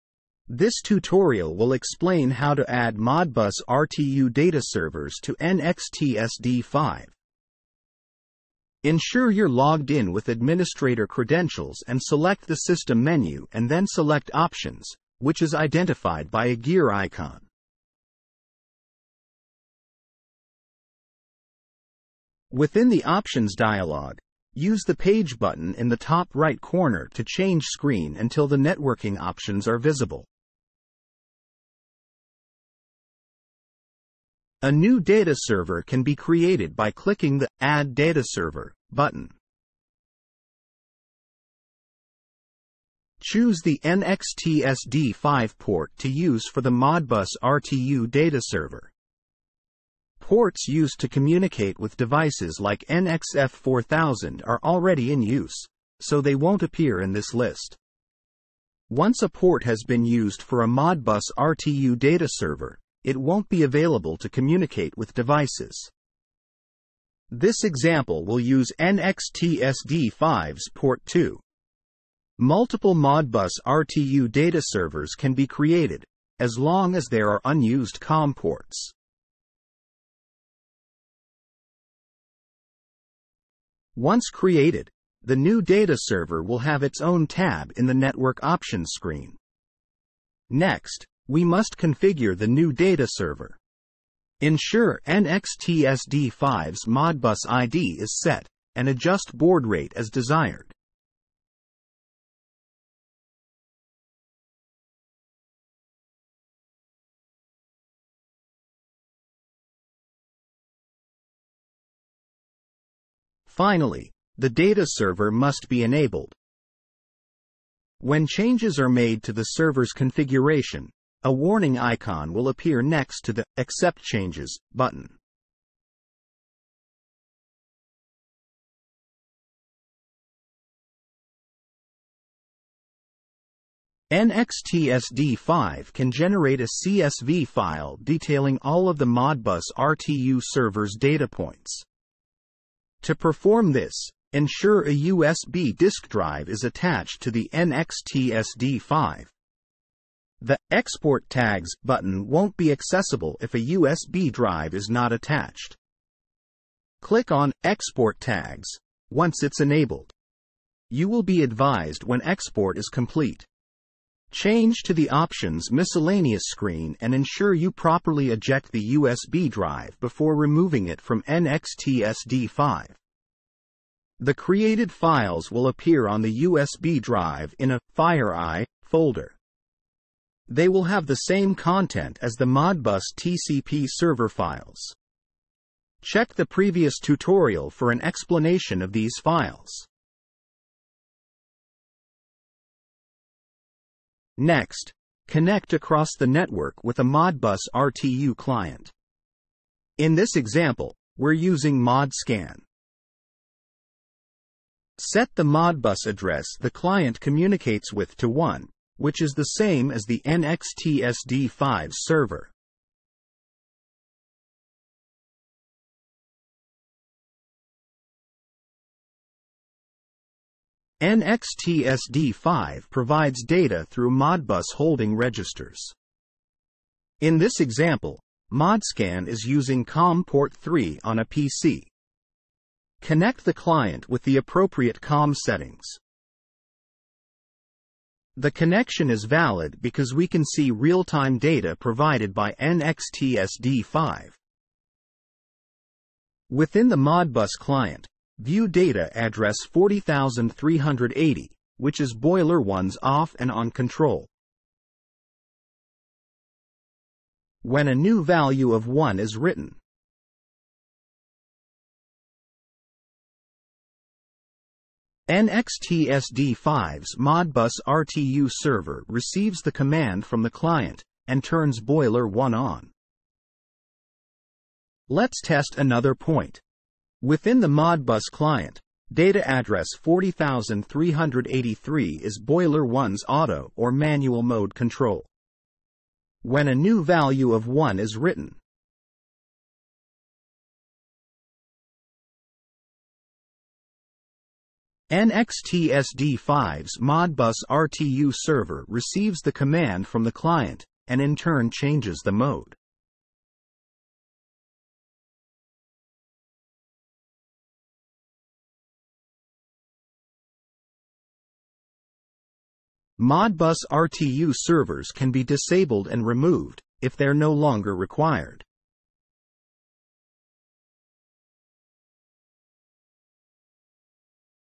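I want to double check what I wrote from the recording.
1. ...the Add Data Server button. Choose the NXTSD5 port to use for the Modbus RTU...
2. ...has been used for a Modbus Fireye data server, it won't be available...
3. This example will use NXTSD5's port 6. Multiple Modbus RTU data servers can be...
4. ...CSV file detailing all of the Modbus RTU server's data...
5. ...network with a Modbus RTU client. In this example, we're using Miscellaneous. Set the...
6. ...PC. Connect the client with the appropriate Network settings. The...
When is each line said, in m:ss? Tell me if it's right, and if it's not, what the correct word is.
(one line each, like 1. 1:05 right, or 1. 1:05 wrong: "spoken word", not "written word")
1. 0:37 right
2. 0:59 wrong: "RTU", not "Fireye"
3. 1:07 wrong: "2", not "6"
4. 2:16 right
5. 3:16 wrong: "ModScan", not "Miscellaneous"
6. 3:51 wrong: "COM", not "Network".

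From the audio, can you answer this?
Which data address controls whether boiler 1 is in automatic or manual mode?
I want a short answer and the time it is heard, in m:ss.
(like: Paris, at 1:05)
40383, at 4:40.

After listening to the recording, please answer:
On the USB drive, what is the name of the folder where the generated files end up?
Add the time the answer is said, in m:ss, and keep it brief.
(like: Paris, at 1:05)
Fireye, at 2:57.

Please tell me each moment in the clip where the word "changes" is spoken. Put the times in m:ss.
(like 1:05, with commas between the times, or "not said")
0:27, 1:58, 2:04, 2:44, 5:01.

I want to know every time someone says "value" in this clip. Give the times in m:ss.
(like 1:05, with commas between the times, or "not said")
4:18, 4:47.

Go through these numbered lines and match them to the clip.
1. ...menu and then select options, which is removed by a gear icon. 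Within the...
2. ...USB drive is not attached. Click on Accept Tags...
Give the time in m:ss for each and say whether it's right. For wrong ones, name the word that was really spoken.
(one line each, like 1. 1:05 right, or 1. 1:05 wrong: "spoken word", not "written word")
1. 0:13 wrong: "identified", not "removed"
2. 2:33 wrong: "Export", not "Accept".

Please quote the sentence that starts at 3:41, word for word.
nxtsd 5 provides data through Modbus holding registers.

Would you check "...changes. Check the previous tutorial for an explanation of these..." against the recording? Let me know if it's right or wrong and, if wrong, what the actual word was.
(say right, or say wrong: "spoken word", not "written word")
wrong: "files", not "changes".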